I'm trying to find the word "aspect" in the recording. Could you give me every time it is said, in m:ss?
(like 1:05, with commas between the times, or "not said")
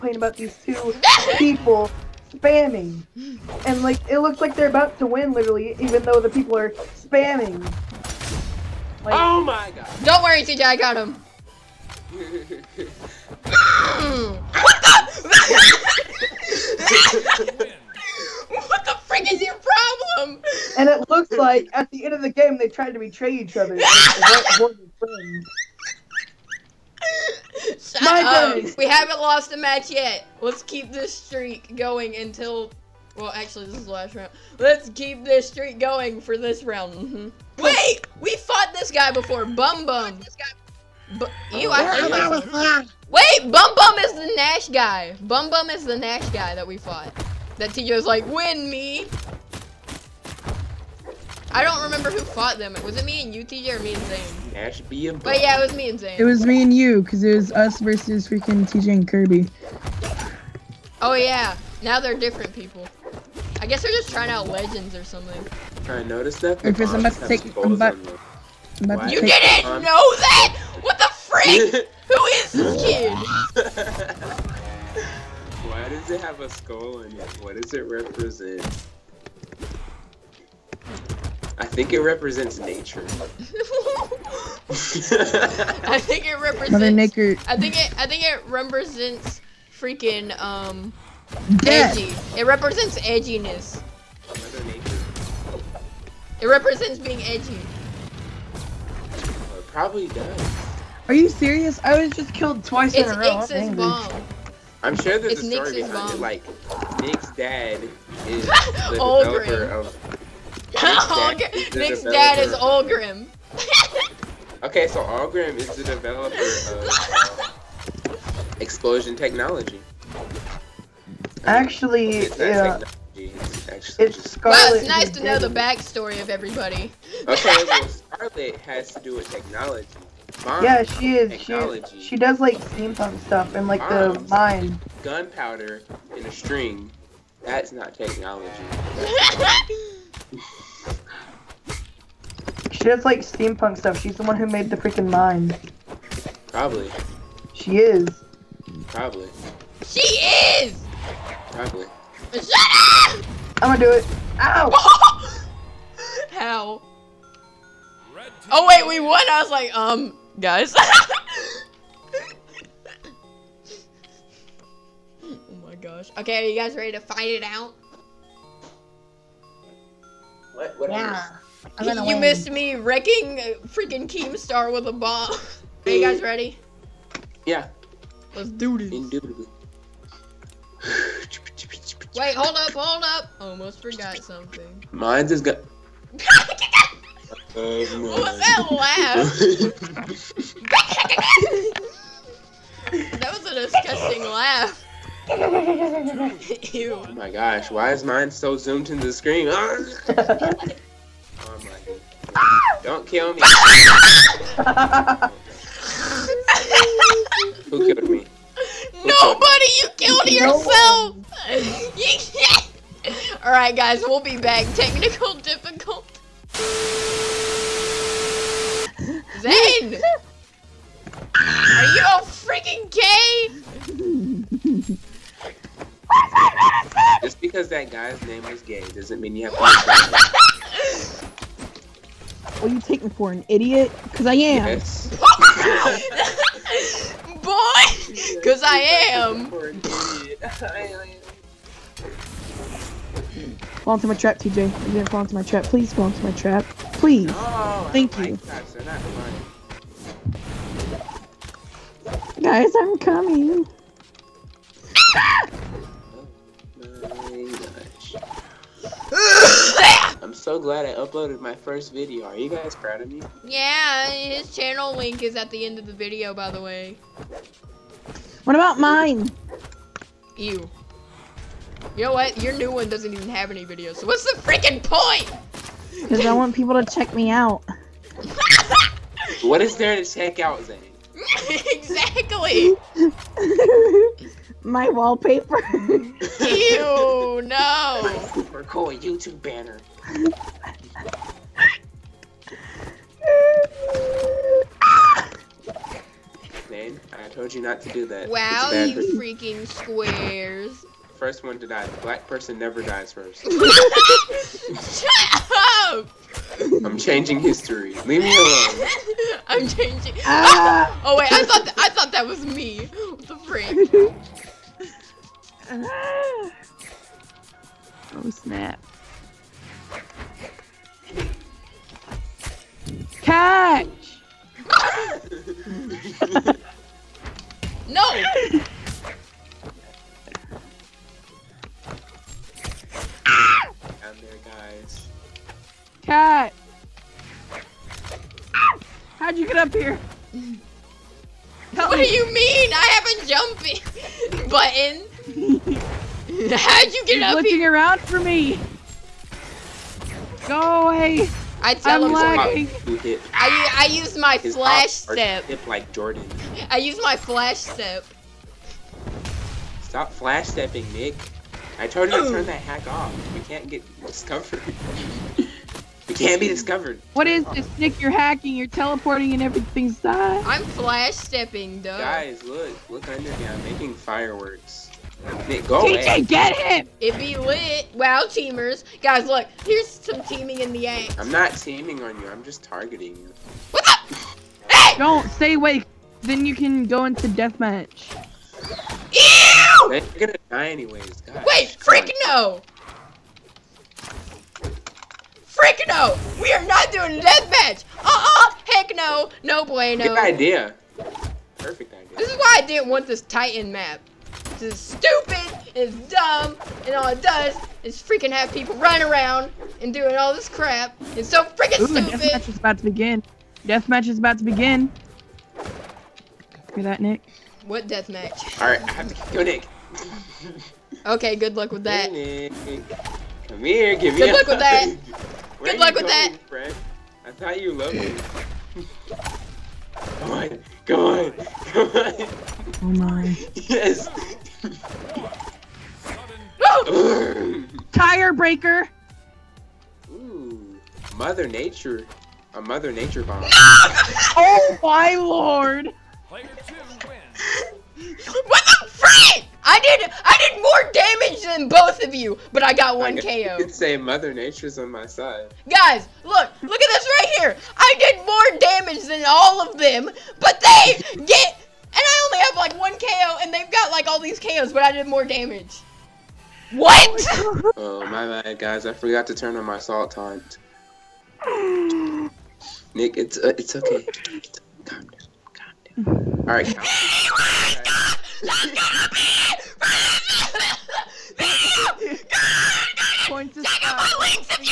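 not said.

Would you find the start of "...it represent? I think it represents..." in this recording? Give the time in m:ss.
1:17.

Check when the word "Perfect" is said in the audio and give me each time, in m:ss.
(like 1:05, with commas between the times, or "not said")
6:41.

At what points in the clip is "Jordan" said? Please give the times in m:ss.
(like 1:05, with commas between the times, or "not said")
5:55.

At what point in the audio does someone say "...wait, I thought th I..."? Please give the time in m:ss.
5:11.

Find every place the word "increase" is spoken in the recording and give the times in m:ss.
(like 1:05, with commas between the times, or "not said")
not said.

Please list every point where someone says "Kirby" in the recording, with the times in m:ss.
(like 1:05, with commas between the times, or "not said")
0:59.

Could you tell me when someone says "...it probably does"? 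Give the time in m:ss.
1:39.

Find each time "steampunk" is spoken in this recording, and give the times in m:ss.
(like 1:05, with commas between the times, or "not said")
2:12, 2:23.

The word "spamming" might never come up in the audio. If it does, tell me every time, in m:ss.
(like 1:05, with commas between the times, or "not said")
0:02, 0:06.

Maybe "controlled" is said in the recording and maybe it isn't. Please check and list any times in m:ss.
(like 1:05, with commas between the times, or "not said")
not said.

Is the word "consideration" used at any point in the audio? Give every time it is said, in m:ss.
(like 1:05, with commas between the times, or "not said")
not said.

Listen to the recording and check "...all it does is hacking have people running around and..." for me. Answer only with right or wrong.
wrong.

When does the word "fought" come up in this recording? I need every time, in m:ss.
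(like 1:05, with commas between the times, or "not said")
0:38, 0:46, 0:52.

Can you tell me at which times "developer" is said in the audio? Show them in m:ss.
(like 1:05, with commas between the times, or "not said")
1:48, 1:55.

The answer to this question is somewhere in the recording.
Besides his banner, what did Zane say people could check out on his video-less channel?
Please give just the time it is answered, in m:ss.
4:44.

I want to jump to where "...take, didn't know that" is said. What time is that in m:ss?
1:09.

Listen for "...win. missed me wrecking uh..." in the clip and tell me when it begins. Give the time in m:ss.
2:52.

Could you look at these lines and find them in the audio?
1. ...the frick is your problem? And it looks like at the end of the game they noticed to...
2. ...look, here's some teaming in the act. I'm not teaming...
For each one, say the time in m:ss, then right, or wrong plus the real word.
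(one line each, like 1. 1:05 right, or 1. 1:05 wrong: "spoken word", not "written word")
1. 0:18 wrong: "tried", not "noticed"
2. 6:19 right.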